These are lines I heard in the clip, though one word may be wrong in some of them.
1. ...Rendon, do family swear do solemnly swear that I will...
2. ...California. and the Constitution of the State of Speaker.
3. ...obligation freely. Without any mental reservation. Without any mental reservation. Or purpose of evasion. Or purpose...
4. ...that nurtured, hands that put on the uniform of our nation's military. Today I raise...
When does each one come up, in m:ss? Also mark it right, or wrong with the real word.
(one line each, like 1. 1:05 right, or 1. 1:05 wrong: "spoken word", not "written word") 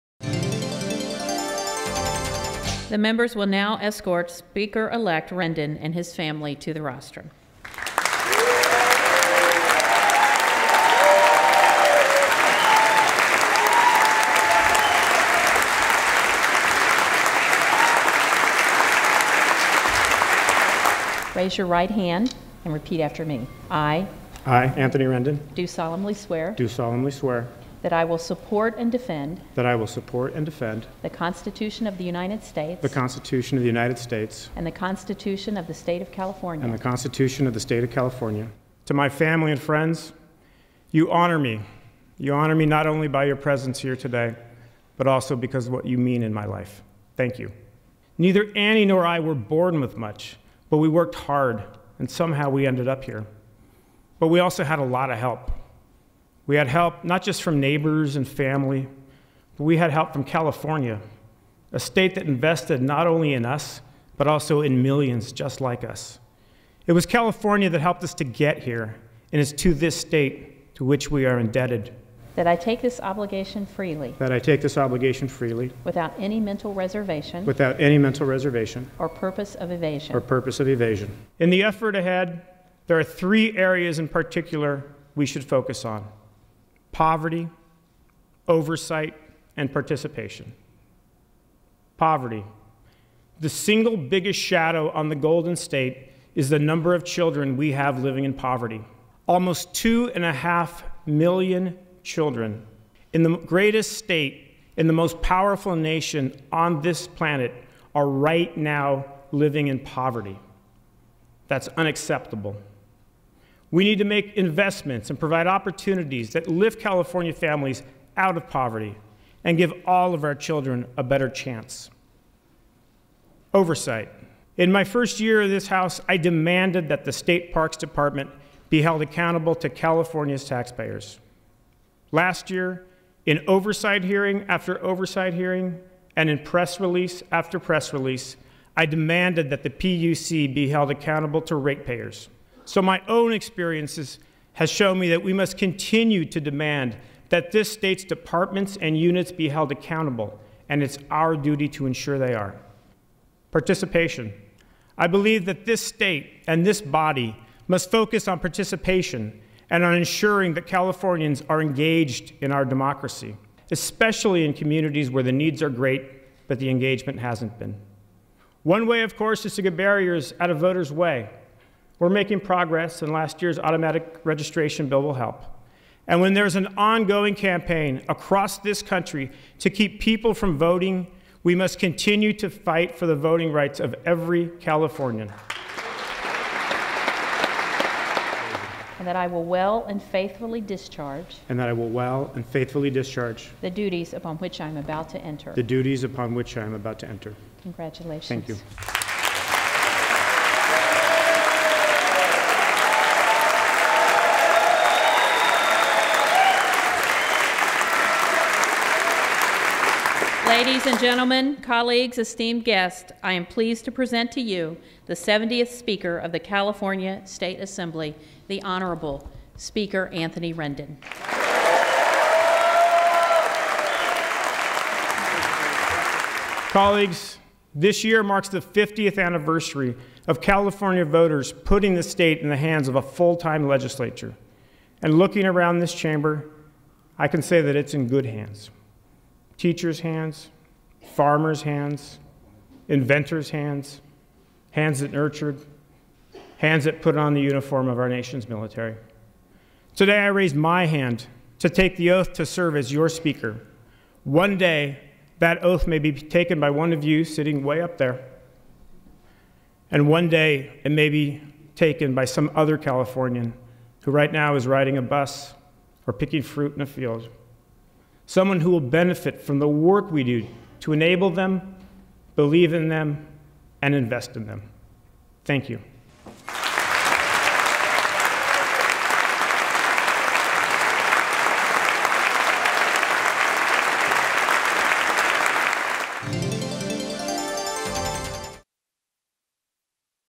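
1. 0:25 wrong: "solemnly", not "family"
2. 0:36 wrong: "California", not "Speaker"
3. 1:14 right
4. 4:05 right.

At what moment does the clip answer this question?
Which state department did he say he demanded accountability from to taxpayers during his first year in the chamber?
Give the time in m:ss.
2:07.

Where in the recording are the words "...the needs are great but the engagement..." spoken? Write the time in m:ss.
2:45.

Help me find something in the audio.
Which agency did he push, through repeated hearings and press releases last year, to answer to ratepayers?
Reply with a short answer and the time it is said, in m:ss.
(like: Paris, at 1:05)
PUC, at 2:19.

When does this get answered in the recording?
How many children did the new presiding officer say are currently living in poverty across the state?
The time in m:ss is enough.
1:39.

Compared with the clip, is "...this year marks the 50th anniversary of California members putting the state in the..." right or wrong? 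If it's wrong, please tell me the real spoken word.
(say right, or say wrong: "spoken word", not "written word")
wrong: "voters", not "members".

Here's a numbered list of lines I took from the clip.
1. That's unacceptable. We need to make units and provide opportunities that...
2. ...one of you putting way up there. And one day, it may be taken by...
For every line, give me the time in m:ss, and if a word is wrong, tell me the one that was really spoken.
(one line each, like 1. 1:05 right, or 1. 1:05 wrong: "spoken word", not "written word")
1. 1:51 wrong: "investments", not "units"
2. 4:16 wrong: "sitting", not "putting".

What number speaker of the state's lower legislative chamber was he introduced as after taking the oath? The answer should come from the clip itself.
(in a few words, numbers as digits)
70th.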